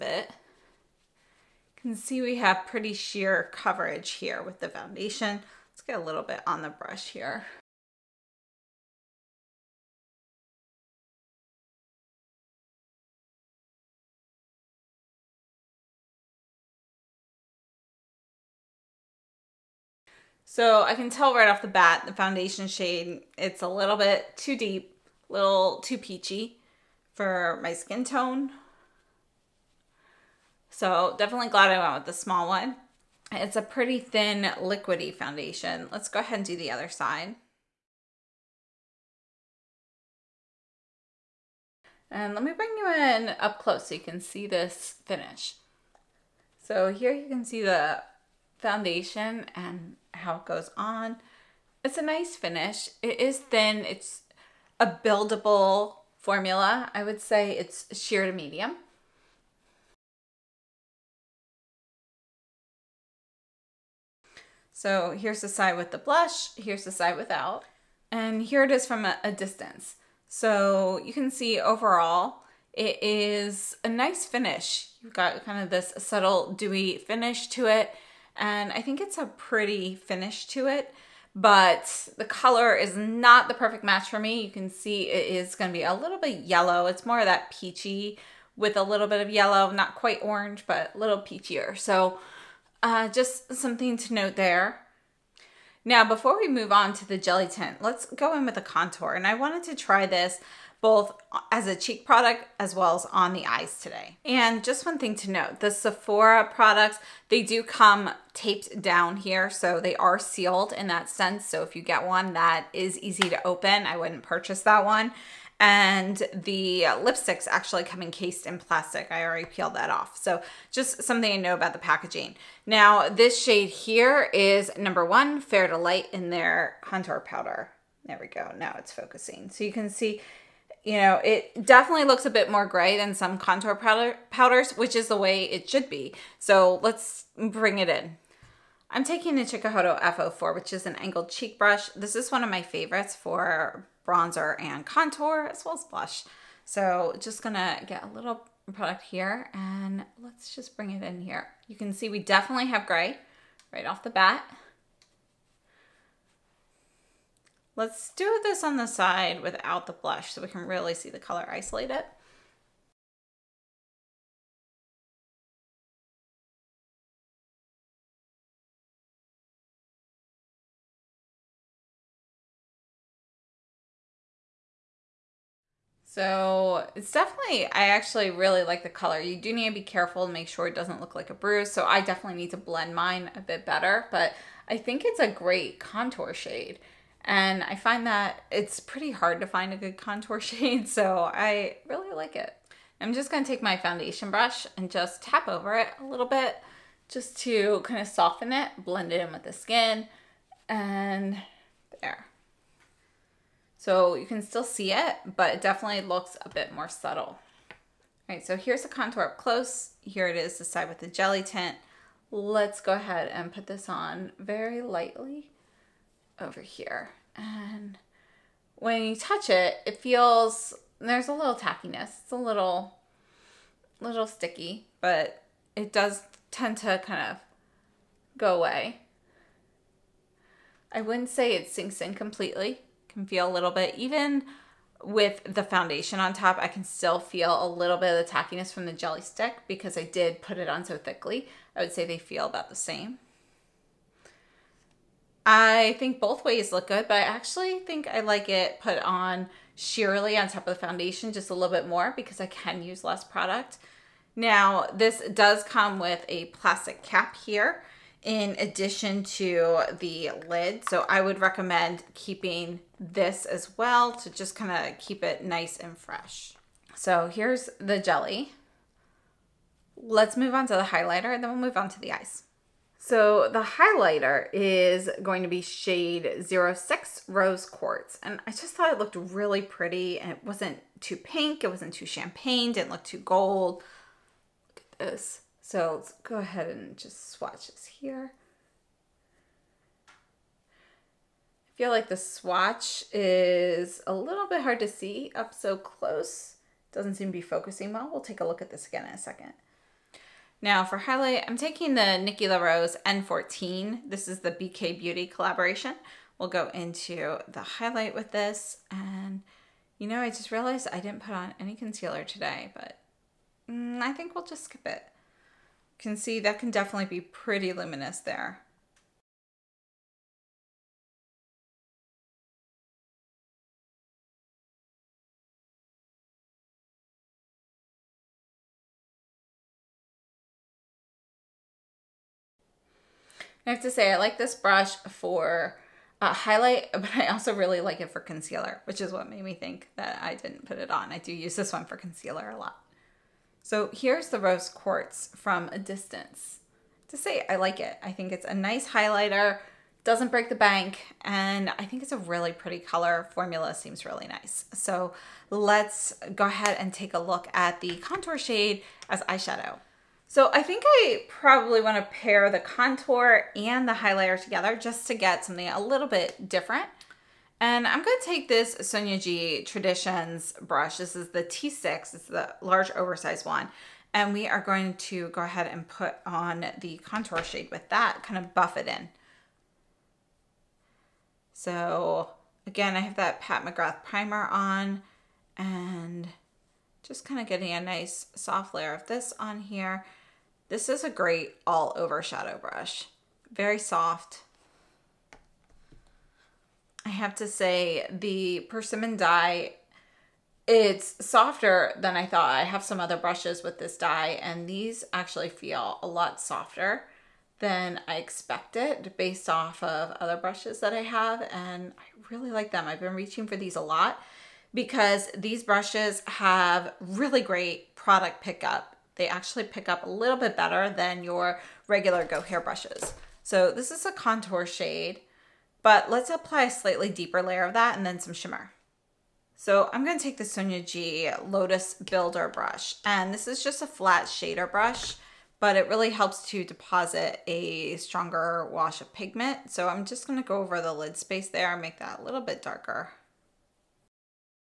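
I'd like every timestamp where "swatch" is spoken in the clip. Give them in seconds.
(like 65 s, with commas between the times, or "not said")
287 s, 292 s.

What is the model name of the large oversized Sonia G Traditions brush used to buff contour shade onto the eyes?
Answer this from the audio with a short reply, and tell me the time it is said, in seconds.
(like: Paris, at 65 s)
T6, at 371 s.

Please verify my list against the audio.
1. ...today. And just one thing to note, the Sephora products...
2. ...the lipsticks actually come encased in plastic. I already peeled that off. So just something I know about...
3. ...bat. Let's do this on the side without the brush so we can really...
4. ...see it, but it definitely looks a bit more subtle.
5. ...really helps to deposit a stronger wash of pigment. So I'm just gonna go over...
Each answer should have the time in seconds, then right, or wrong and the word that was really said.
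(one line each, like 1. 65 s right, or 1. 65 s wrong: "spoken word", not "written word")
1. 103 s right
2. 116 s right
3. 154 s wrong: "blush", not "brush"
4. 204 s right
5. 435 s right.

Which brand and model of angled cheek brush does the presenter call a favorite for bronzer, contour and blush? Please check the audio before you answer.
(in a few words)
Chikuhodo F04.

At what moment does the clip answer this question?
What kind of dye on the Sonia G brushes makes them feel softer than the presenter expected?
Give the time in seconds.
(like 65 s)
398 s.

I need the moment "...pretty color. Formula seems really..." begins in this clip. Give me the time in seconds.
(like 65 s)
352 s.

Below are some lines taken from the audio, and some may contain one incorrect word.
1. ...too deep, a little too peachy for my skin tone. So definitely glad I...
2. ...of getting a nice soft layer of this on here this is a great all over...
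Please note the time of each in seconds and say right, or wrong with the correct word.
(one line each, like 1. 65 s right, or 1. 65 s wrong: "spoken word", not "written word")
1. 24 s right
2. 387 s right.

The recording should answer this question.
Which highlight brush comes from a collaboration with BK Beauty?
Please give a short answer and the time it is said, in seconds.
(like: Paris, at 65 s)
Nikki LaRose N14, at 302 s.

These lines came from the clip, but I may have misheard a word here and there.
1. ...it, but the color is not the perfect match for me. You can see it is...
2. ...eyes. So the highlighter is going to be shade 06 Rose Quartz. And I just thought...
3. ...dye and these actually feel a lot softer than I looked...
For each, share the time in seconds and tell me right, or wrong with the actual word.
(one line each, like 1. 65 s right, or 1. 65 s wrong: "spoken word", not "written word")
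1. 80 s right
2. 272 s right
3. 403 s wrong: "expected", not "looked".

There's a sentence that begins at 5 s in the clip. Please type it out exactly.
Let's get a little bit on the brush here.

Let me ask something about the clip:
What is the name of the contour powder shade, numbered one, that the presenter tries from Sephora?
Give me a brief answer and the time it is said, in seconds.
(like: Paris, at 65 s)
Fair to Light, at 125 s.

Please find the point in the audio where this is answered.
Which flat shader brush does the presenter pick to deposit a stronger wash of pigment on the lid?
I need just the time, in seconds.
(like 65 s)
430 s.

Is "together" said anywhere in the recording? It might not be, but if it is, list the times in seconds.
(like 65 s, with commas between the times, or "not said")
364 s.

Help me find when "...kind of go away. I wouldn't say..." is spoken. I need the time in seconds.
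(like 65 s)
227 s.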